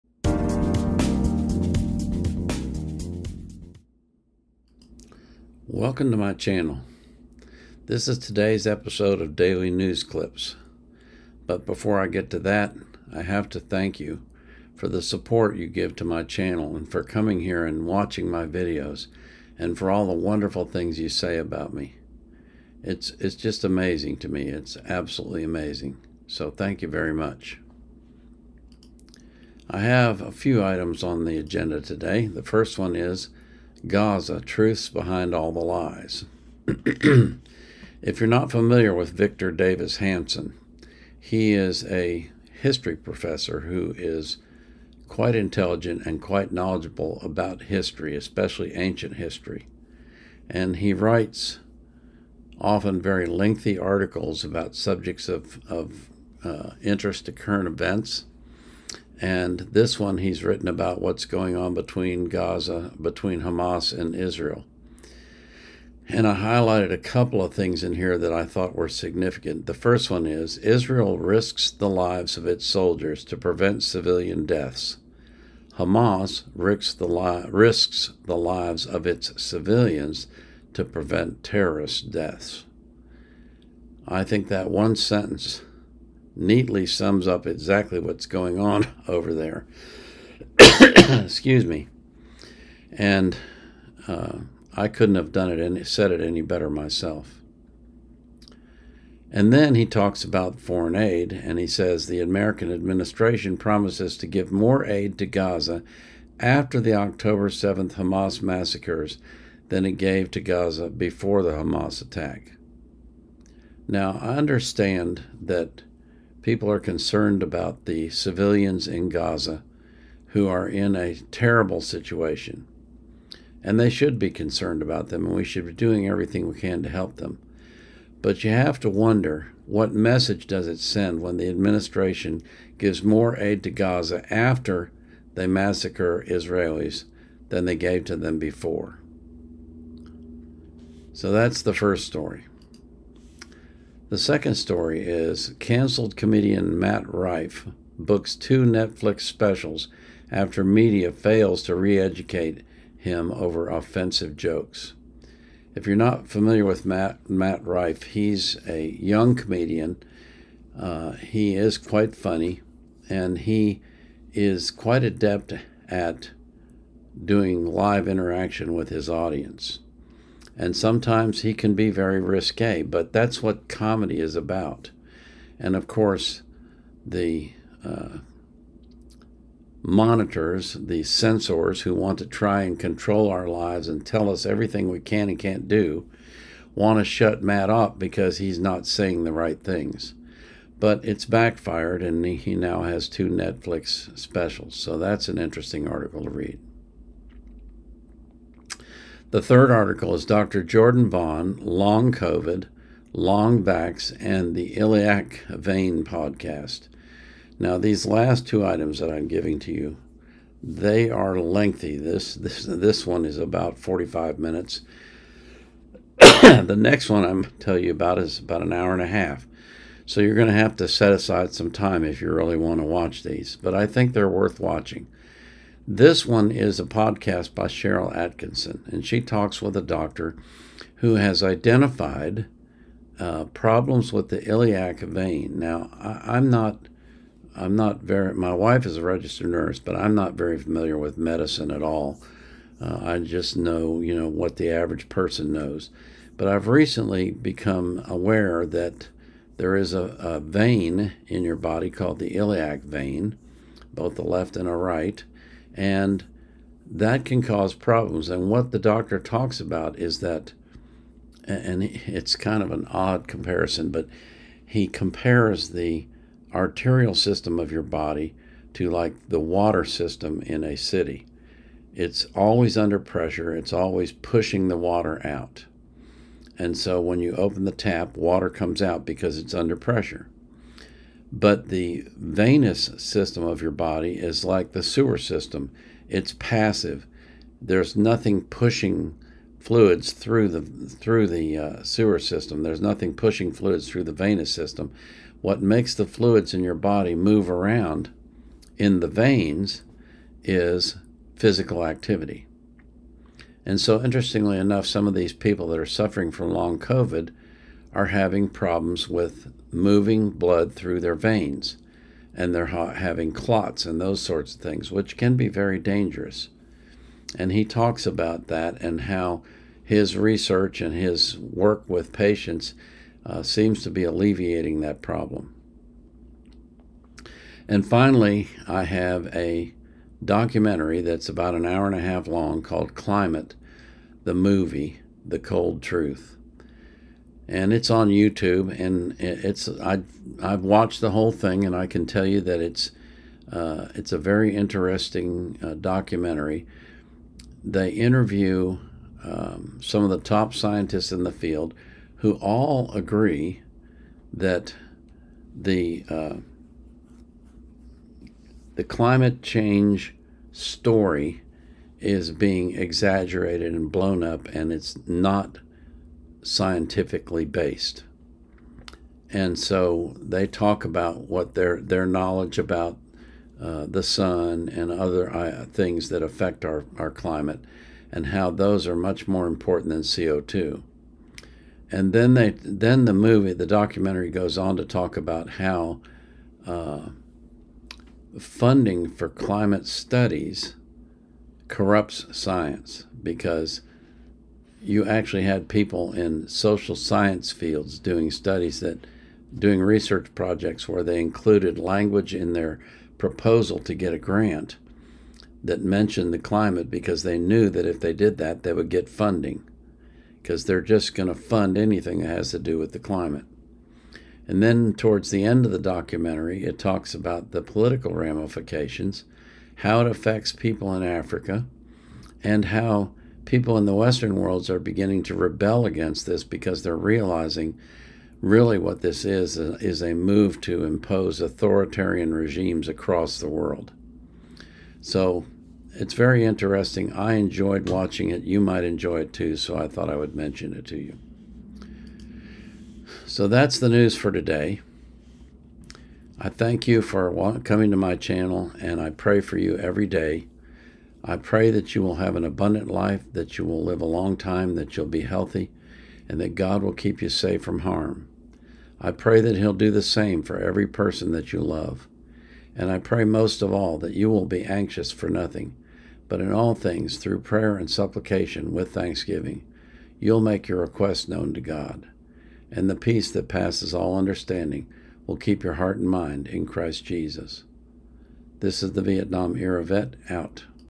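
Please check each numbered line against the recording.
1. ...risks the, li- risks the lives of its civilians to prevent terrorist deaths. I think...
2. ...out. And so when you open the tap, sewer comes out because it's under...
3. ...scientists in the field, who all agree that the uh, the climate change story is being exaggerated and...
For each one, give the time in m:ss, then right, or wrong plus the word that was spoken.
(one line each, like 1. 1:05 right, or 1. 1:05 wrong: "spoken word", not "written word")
1. 1:16 right
2. 4:35 wrong: "water", not "sewer"
3. 5:50 right.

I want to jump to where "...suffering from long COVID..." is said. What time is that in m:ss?
5:05.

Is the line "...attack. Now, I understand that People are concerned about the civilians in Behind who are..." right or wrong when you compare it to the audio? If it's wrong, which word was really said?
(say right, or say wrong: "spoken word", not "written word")
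wrong: "Gaza", not "Behind".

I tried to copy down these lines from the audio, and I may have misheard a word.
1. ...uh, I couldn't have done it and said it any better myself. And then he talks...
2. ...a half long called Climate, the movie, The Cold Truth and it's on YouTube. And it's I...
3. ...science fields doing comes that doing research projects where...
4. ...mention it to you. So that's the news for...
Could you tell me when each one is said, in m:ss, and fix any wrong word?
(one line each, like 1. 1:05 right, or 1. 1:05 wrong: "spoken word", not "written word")
1. 1:34 right
2. 5:31 right
3. 6:36 wrong: "studies", not "comes"
4. 7:20 right.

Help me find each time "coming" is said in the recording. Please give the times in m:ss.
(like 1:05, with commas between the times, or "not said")
0:17, 7:27.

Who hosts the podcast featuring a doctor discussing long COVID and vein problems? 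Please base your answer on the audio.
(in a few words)
Sharyl Attkisson.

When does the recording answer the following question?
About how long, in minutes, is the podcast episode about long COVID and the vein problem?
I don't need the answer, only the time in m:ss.
3:33.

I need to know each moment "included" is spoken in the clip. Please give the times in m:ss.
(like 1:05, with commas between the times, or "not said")
6:41.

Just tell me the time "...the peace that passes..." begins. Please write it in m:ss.
7:52.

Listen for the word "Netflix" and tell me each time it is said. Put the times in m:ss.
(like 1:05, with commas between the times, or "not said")
2:28, 3:13.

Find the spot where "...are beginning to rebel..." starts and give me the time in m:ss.
7:04.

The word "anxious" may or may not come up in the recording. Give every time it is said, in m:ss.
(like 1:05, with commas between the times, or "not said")
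7:44.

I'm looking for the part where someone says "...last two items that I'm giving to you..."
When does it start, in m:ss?
3:28.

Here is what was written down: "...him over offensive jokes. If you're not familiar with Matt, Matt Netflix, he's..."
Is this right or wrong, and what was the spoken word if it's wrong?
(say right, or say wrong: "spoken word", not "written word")
wrong: "Rife", not "Netflix".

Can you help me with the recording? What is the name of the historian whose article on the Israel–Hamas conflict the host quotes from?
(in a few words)
Victor Davis Hanson.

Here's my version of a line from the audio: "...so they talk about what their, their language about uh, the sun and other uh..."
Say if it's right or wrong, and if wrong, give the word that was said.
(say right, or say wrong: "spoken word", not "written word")
wrong: "knowledge", not "language".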